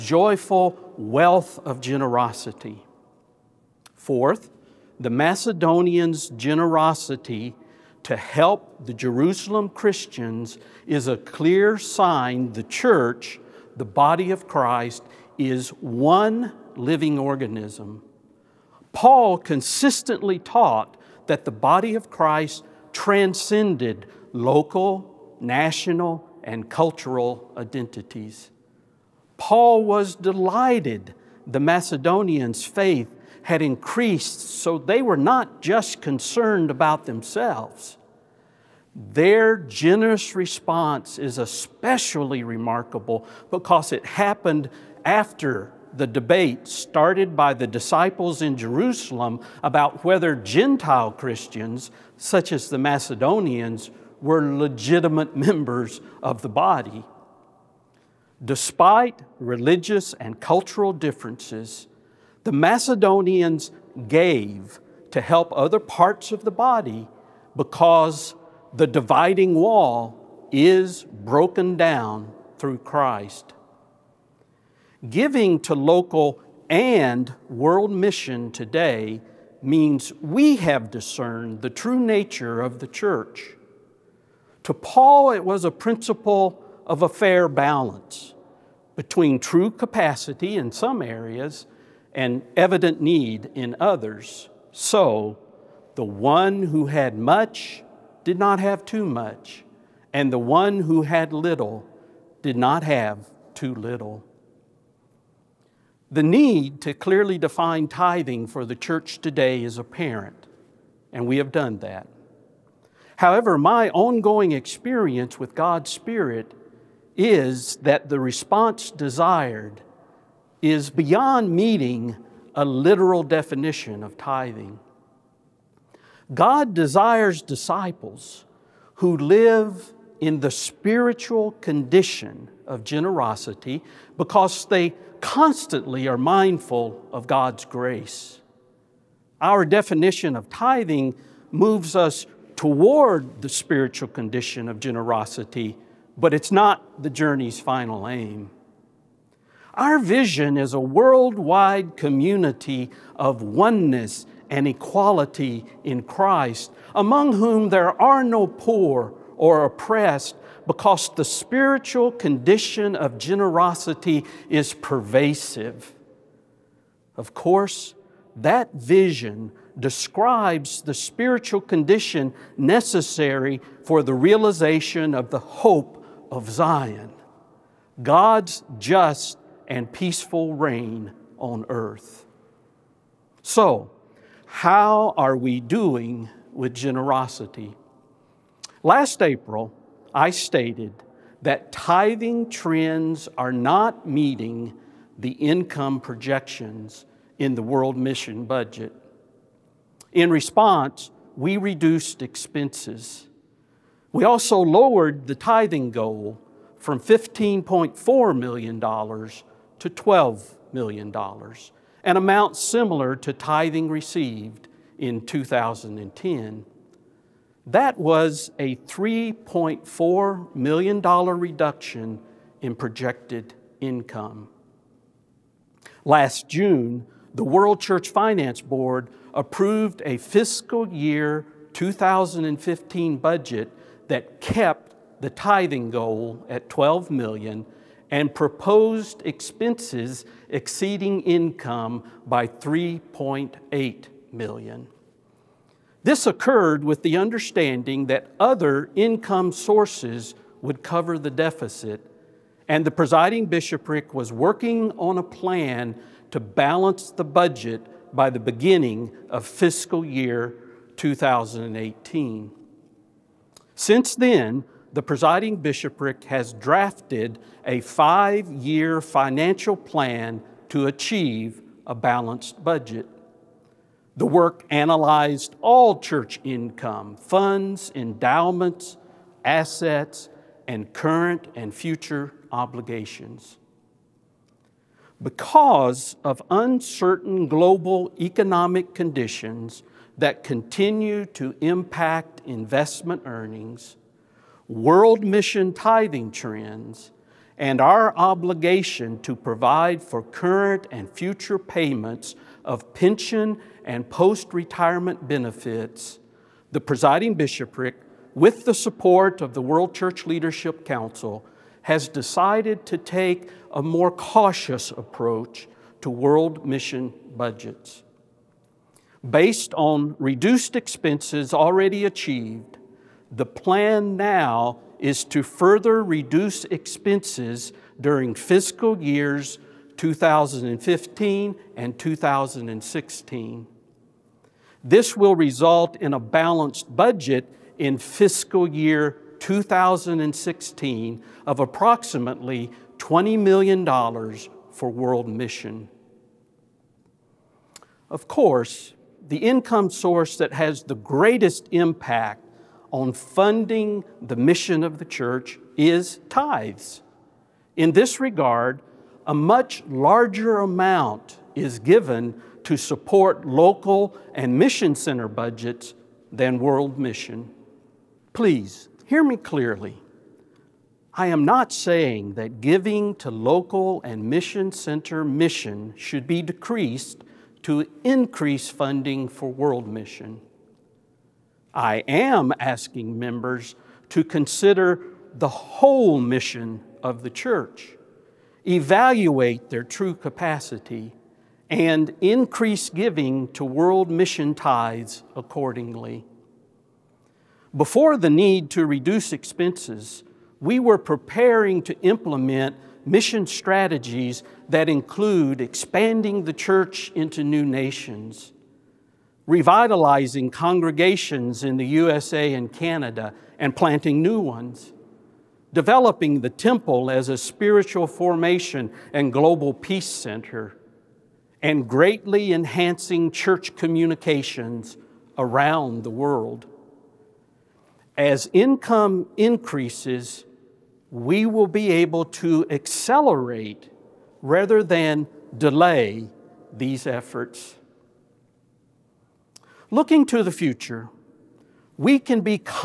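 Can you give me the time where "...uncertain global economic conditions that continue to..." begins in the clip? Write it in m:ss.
4:46.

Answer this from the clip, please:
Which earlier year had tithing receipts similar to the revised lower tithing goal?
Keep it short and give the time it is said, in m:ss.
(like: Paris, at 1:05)
2010, at 3:35.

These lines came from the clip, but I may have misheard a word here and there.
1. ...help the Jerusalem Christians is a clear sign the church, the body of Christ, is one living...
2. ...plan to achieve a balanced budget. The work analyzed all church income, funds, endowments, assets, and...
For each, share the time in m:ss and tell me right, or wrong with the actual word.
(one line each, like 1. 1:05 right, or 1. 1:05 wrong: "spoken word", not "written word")
1. 0:08 right
2. 4:29 right.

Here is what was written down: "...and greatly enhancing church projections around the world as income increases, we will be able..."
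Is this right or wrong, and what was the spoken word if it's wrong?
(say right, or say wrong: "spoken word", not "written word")
wrong: "communications", not "projections".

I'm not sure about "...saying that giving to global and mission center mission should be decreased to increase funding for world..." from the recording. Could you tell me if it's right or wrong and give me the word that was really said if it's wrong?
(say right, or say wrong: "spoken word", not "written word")
wrong: "local", not "global".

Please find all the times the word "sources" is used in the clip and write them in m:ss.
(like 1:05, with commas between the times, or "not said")
4:09, 5:49.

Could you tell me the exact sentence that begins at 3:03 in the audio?
So, how are we doing with generosity?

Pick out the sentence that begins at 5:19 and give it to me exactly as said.
Based on reduced expenses already achieved, the plan now is to further reduce expenses during fiscal years 2015 and 2016.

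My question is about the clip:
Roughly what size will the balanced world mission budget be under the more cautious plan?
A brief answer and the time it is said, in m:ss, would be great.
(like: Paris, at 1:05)
$20 million, at 5:42.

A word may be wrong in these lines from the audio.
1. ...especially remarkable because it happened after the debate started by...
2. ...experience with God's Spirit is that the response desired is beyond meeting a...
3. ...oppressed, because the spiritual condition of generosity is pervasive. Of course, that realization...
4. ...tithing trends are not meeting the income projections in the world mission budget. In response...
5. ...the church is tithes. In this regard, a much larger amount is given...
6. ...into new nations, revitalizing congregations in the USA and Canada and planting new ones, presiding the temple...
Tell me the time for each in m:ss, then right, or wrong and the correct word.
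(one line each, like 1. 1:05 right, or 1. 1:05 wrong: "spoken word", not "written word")
1. 0:41 right
2. 1:54 right
3. 2:39 wrong: "vision", not "realization"
4. 3:11 right
5. 5:54 right
6. 6:47 wrong: "developing", not "presiding".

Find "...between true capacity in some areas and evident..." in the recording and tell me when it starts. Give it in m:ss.
1:28.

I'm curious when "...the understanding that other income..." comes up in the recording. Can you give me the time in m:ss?
4:07.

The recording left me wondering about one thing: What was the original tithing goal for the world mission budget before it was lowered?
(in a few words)
$15.4 million.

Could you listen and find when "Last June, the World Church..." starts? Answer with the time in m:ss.
3:46.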